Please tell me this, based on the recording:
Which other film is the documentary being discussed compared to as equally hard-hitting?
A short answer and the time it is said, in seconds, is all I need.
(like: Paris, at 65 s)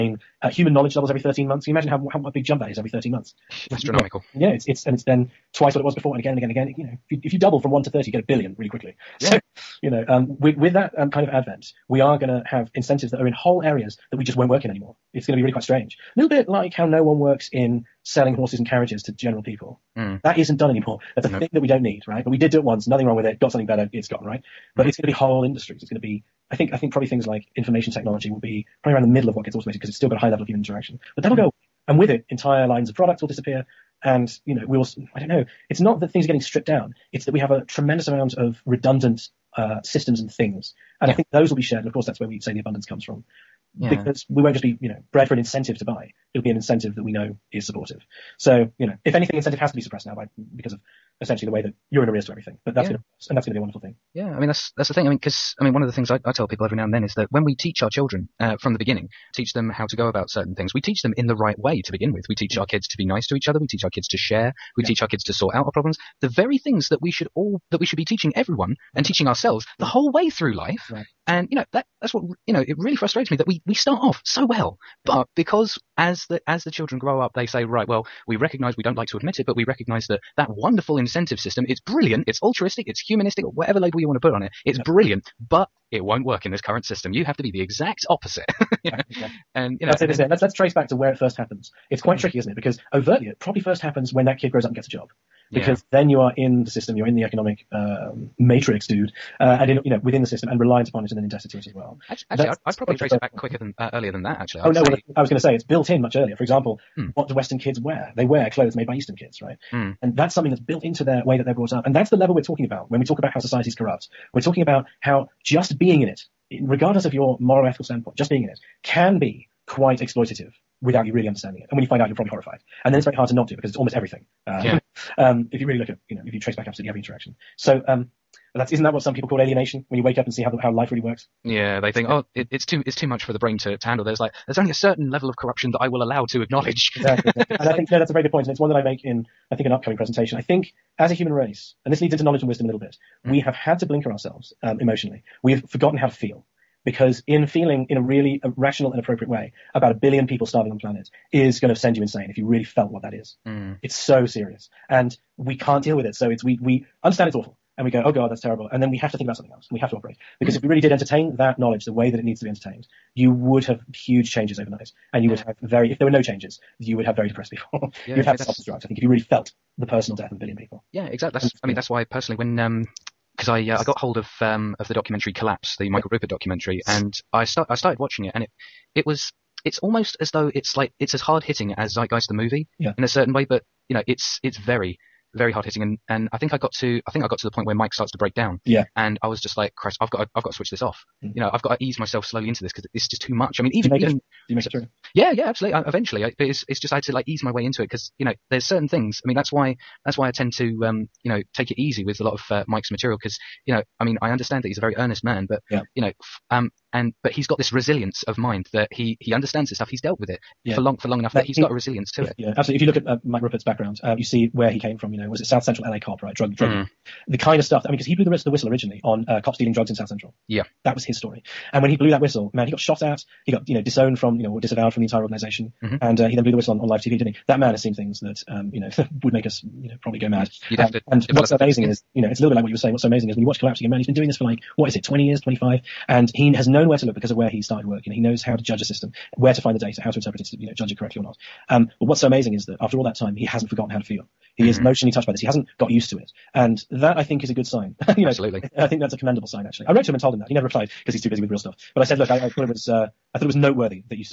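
Zeitgeist, at 181 s.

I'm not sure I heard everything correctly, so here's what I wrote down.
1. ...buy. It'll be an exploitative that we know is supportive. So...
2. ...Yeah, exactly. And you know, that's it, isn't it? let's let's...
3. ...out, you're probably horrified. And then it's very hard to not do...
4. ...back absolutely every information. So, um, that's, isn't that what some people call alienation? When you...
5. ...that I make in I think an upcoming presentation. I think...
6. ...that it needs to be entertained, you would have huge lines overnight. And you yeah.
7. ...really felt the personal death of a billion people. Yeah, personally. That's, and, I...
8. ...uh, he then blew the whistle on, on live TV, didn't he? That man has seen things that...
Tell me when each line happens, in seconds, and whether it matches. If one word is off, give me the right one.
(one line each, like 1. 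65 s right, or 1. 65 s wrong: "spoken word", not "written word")
1. 45 s wrong: "incentive", not "exploitative"
2. 88 s right
3. 122 s right
4. 126 s wrong: "interaction", not "information"
5. 138 s right
6. 162 s wrong: "changes", not "lines"
7. 169 s wrong: "exactly", not "personally"
8. 226 s right.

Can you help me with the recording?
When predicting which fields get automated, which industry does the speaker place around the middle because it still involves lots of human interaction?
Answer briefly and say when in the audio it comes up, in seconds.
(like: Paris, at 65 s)
Information technology, at 27 s.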